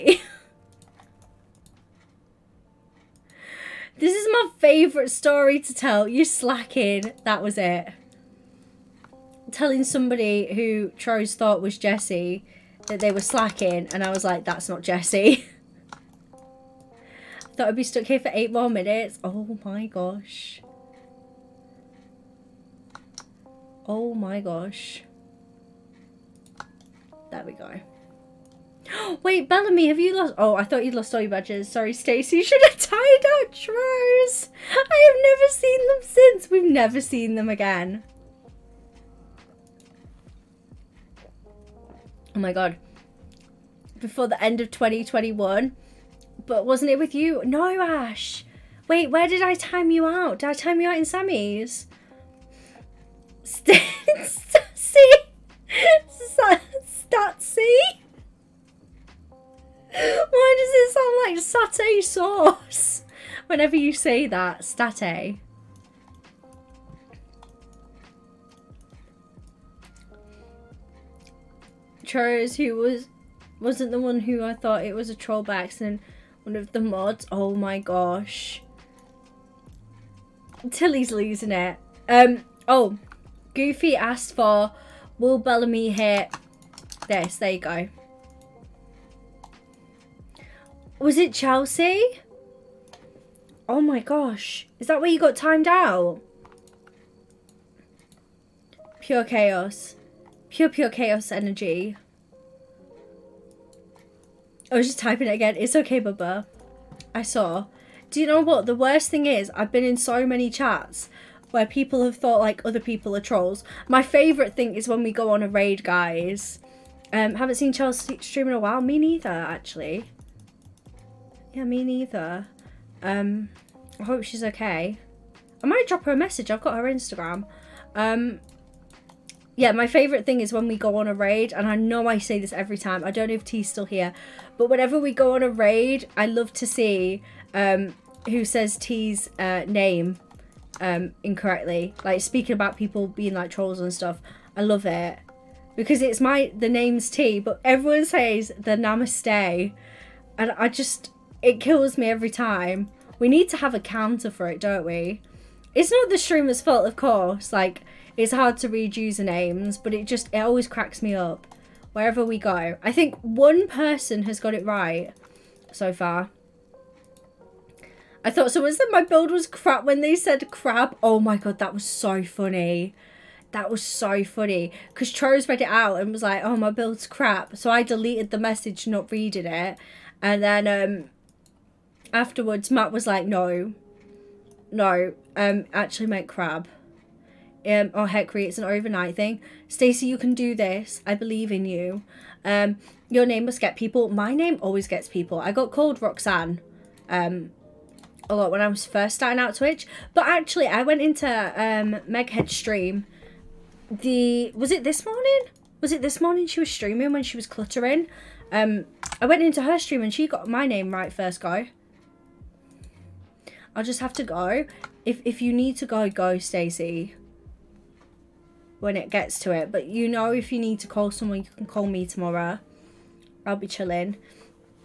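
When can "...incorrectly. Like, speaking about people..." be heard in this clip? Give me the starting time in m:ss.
2:21.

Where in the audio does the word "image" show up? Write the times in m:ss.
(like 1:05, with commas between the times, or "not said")
not said.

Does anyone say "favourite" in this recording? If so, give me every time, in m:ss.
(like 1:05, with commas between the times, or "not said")
0:04, 1:54, 2:09.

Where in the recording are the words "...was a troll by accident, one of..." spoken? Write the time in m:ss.
1:14.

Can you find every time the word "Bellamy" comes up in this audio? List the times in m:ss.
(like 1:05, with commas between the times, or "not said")
0:29, 1:25.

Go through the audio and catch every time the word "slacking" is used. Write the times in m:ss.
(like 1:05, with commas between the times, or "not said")
0:06, 0:13.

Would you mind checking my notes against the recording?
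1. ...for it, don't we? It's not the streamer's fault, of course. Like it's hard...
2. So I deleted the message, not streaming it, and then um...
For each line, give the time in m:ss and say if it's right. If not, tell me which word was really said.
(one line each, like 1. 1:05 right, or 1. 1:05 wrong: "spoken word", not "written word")
1. 2:34 right
2. 2:57 wrong: "reading", not "streaming".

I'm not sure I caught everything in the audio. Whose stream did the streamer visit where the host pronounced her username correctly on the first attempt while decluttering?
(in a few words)
Meghead.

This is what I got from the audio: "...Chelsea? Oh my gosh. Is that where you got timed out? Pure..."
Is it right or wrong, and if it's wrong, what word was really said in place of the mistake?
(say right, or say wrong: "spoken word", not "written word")
right.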